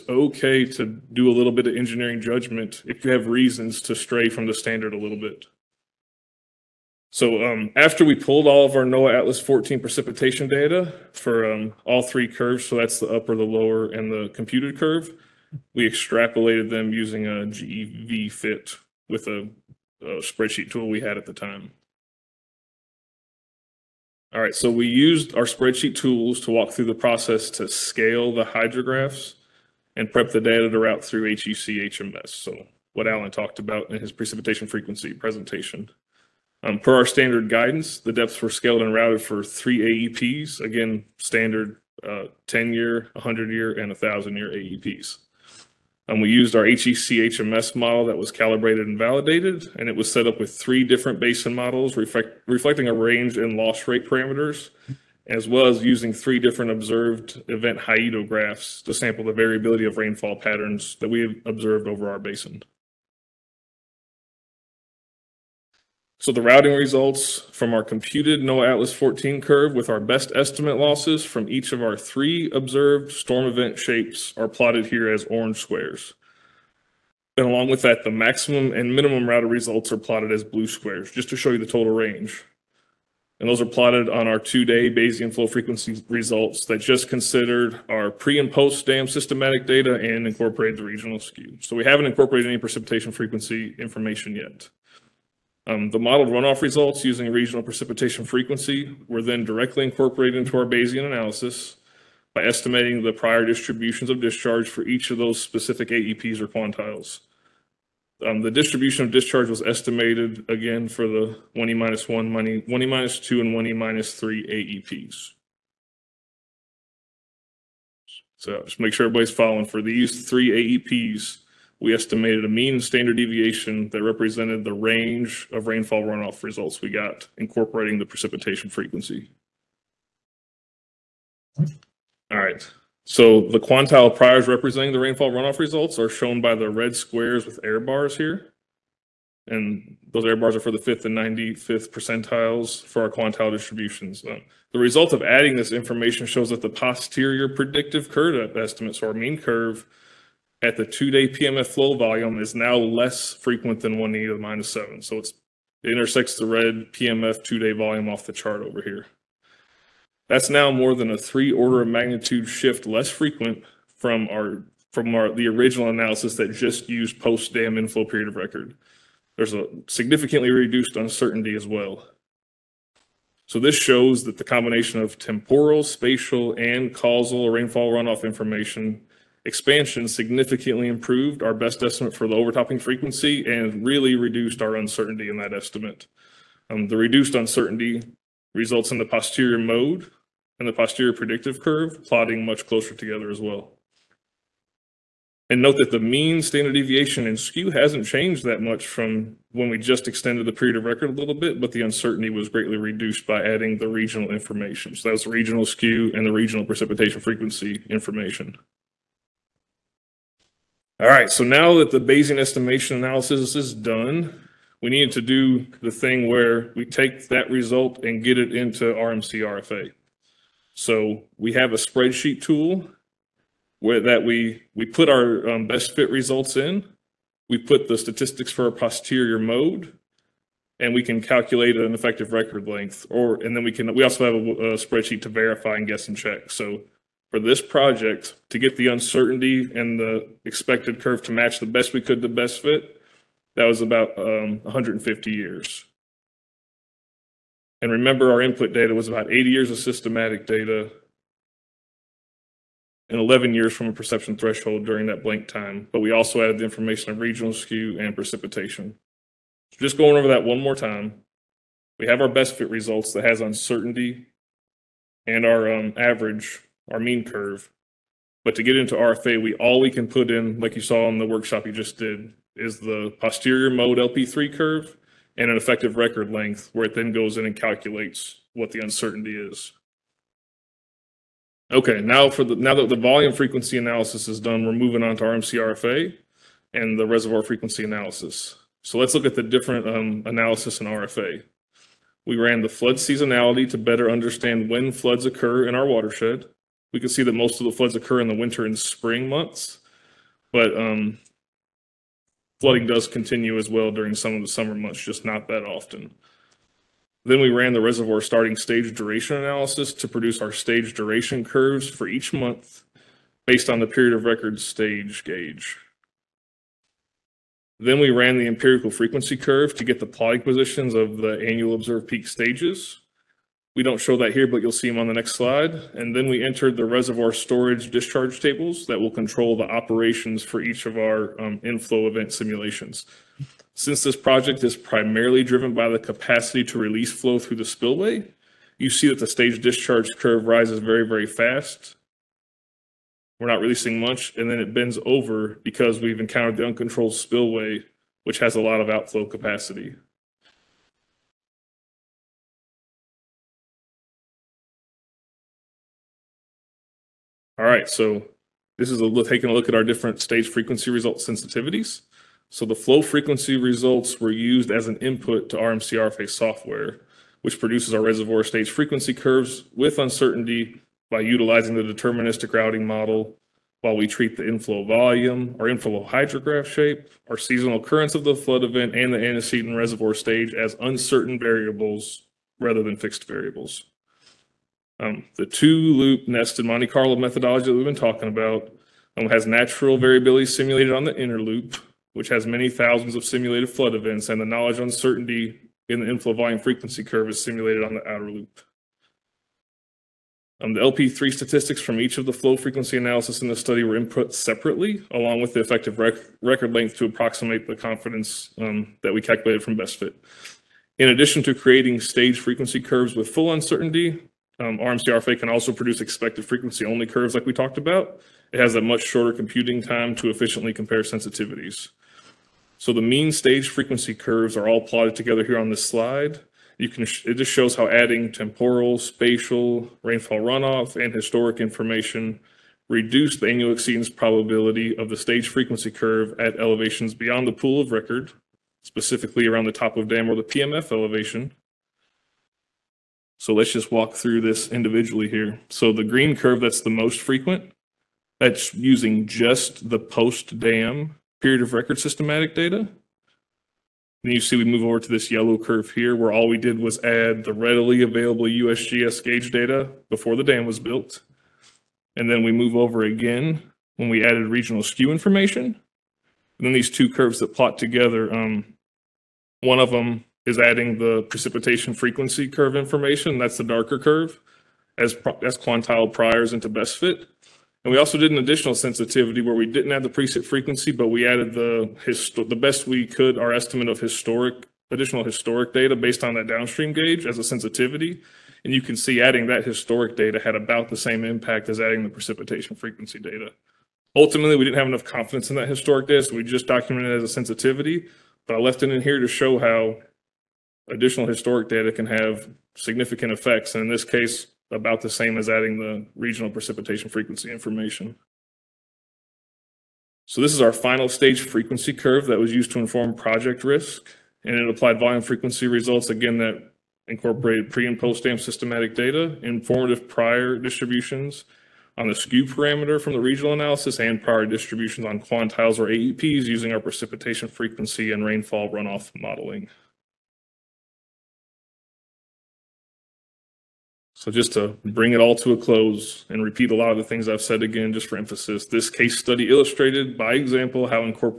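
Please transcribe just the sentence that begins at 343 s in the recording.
We're not releasing much, and then it bends over because we've encountered the uncontrolled spillway, which has a lot of outflow capacity.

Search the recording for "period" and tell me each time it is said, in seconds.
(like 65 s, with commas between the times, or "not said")
168 s, 200 s, 313 s, 451 s.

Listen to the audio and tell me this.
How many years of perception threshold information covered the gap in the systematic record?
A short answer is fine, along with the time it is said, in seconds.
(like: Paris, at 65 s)
11 years, at 253 s.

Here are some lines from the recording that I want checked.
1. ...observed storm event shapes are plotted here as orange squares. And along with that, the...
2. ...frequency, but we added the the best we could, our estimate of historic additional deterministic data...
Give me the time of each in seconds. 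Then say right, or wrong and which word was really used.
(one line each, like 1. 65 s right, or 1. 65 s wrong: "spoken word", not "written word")
1. 72 s right
2. 480 s wrong: "historic", not "deterministic".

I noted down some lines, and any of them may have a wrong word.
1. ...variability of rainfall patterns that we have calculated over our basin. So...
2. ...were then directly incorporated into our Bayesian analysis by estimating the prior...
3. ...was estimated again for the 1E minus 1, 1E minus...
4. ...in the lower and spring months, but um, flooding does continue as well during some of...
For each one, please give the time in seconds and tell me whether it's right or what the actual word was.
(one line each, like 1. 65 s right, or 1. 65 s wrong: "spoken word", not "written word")
1. 59 s wrong: "observed", not "calculated"
2. 99 s right
3. 109 s right
4. 298 s wrong: "winter", not "lower".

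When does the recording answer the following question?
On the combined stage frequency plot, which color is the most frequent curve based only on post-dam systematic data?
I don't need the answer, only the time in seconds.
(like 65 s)
446 s.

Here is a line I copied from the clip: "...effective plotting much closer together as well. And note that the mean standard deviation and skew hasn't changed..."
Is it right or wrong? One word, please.
wrong.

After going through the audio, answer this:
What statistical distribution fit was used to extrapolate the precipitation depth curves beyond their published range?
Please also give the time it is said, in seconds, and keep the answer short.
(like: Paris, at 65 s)
GEV fit, at 17 s.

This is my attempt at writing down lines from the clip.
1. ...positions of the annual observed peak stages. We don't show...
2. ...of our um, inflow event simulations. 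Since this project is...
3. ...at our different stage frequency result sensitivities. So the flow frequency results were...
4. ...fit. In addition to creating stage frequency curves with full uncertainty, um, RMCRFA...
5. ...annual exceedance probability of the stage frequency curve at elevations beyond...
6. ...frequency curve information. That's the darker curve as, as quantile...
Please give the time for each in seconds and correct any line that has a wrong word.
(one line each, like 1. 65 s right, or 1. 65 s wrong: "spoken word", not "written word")
1. 320 s right
2. 330 s right
3. 359 s right
4. 409 s right
5. 433 s right
6. 471 s right.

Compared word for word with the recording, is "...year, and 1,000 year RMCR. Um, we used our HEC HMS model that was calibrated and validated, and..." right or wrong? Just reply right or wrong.
wrong.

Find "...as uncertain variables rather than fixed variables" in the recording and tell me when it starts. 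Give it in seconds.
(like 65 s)
380 s.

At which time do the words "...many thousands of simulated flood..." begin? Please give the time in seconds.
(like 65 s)
392 s.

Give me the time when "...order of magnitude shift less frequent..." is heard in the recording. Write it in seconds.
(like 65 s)
161 s.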